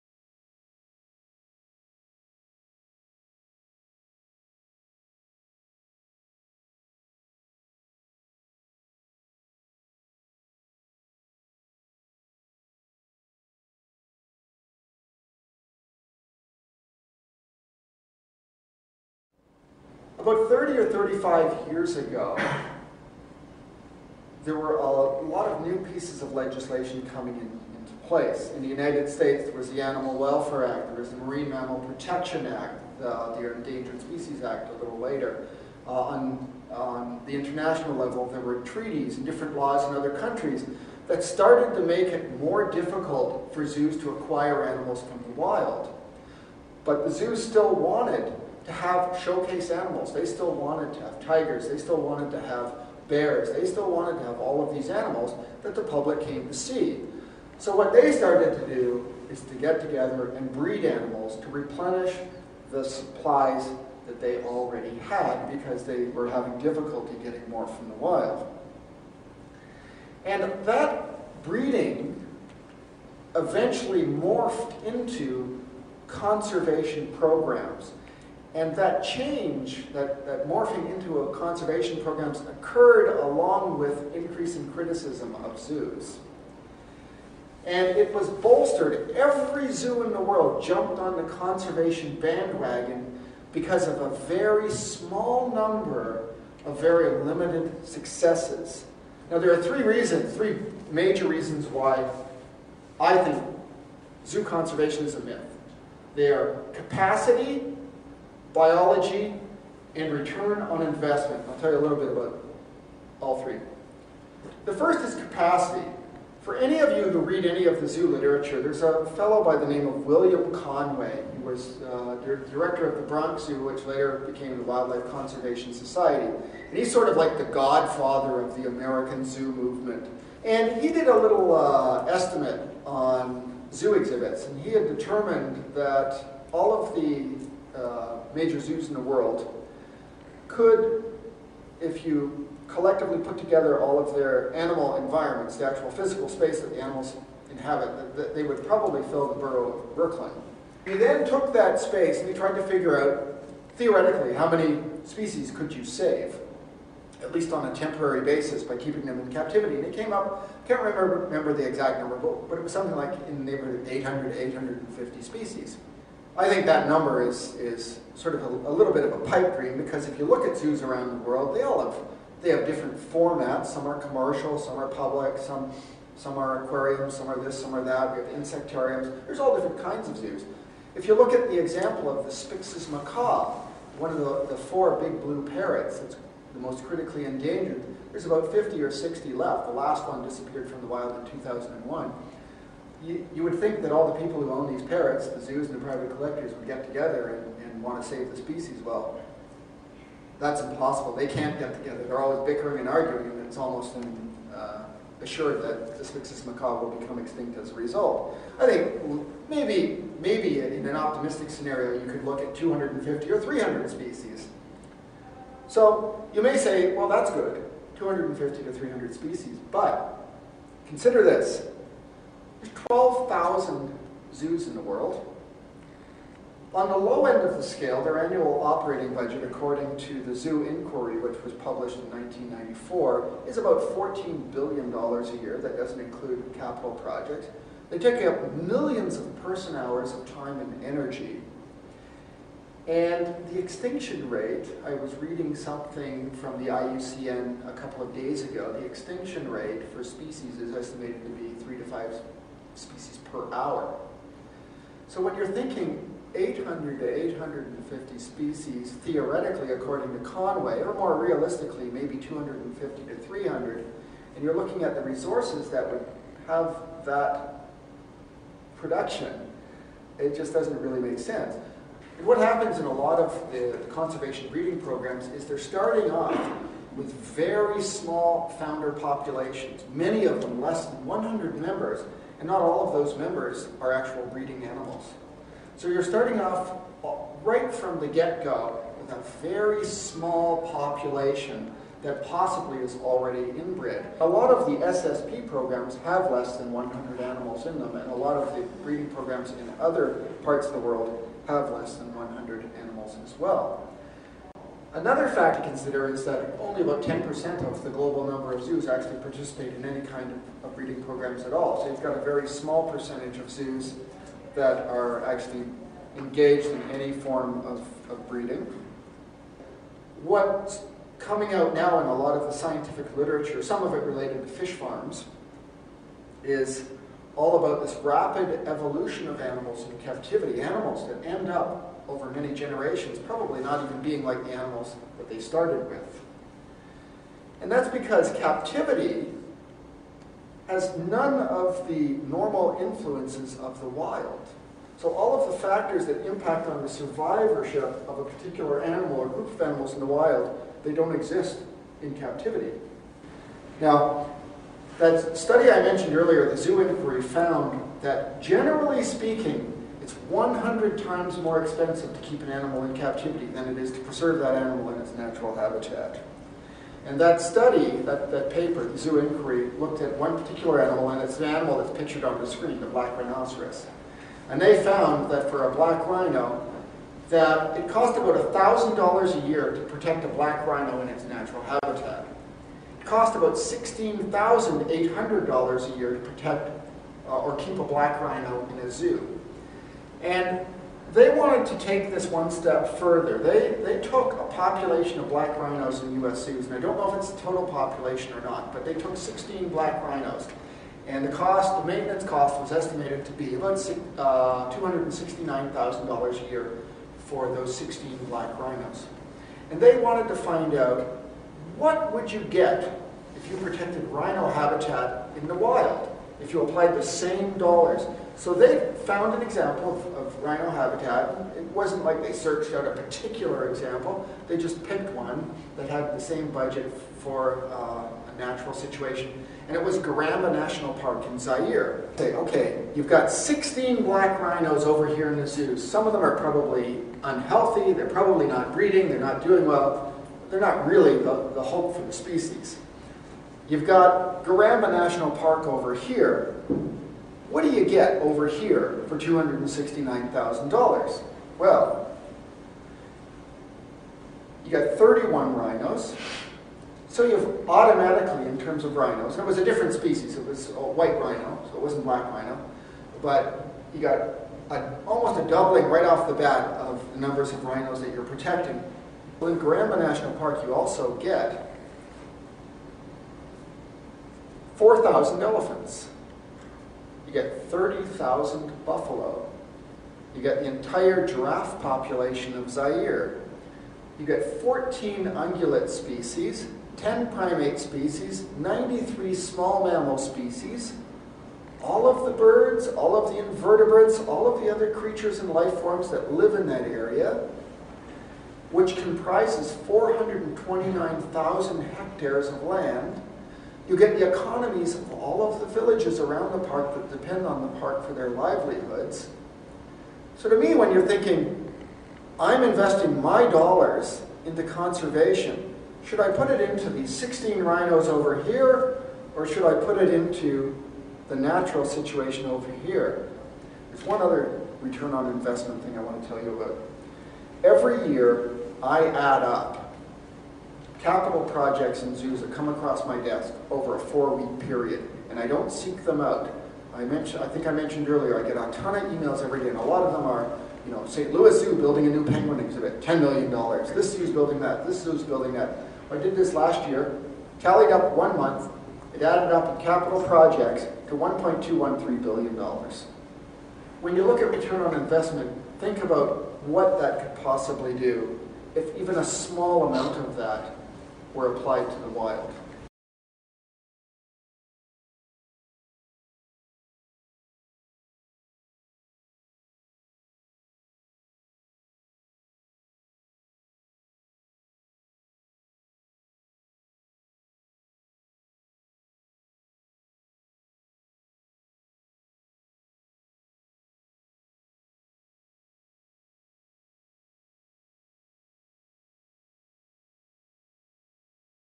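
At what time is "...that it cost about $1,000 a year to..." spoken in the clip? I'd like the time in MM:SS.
06:17.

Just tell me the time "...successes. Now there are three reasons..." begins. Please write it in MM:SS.
01:37.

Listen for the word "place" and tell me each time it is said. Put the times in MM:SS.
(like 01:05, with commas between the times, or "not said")
00:28.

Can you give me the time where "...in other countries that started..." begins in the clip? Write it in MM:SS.
00:39.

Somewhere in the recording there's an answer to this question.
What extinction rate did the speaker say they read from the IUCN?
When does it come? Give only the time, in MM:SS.
04:11.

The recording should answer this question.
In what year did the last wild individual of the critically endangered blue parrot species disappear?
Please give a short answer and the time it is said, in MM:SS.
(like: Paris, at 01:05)
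2001, at 03:11.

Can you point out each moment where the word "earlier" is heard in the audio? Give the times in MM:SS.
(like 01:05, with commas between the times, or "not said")
05:56, 08:58.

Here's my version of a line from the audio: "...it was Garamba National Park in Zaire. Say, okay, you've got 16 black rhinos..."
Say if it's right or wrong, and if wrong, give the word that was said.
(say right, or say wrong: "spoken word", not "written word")
right.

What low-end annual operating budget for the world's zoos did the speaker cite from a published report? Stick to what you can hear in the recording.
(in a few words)
$14 billion.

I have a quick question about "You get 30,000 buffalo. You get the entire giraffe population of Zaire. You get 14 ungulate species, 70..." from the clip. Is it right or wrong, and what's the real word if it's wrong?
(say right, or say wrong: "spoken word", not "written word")
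wrong: "10", not "70".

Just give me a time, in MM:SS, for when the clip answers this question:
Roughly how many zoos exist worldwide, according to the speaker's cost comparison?
03:42.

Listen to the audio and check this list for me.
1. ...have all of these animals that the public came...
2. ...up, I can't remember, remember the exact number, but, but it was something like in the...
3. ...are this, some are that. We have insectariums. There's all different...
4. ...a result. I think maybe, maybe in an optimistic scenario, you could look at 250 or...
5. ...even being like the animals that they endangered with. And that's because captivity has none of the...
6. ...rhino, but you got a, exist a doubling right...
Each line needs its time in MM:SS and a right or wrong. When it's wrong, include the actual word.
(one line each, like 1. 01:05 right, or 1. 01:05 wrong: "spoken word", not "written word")
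1. 00:54 right
2. 02:40 right
3. 02:57 right
4. 03:27 right
5. 05:33 wrong: "started", not "endangered"
6. 07:42 wrong: "almost", not "exist".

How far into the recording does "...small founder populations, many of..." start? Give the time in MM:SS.
04:37.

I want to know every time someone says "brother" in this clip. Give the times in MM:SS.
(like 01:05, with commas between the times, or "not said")
not said.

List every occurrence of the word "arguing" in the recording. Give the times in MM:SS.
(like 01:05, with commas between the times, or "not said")
03:22.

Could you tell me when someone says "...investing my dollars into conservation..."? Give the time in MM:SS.
08:32.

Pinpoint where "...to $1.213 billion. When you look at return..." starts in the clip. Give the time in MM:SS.
09:11.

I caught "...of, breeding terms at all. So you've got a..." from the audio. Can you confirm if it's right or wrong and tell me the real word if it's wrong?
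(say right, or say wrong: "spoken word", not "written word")
wrong: "programs", not "terms".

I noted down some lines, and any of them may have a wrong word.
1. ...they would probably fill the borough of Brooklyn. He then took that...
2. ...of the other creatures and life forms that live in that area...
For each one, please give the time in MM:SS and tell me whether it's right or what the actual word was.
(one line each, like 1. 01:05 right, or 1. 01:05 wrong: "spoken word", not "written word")
1. 02:28 right
2. 08:14 right.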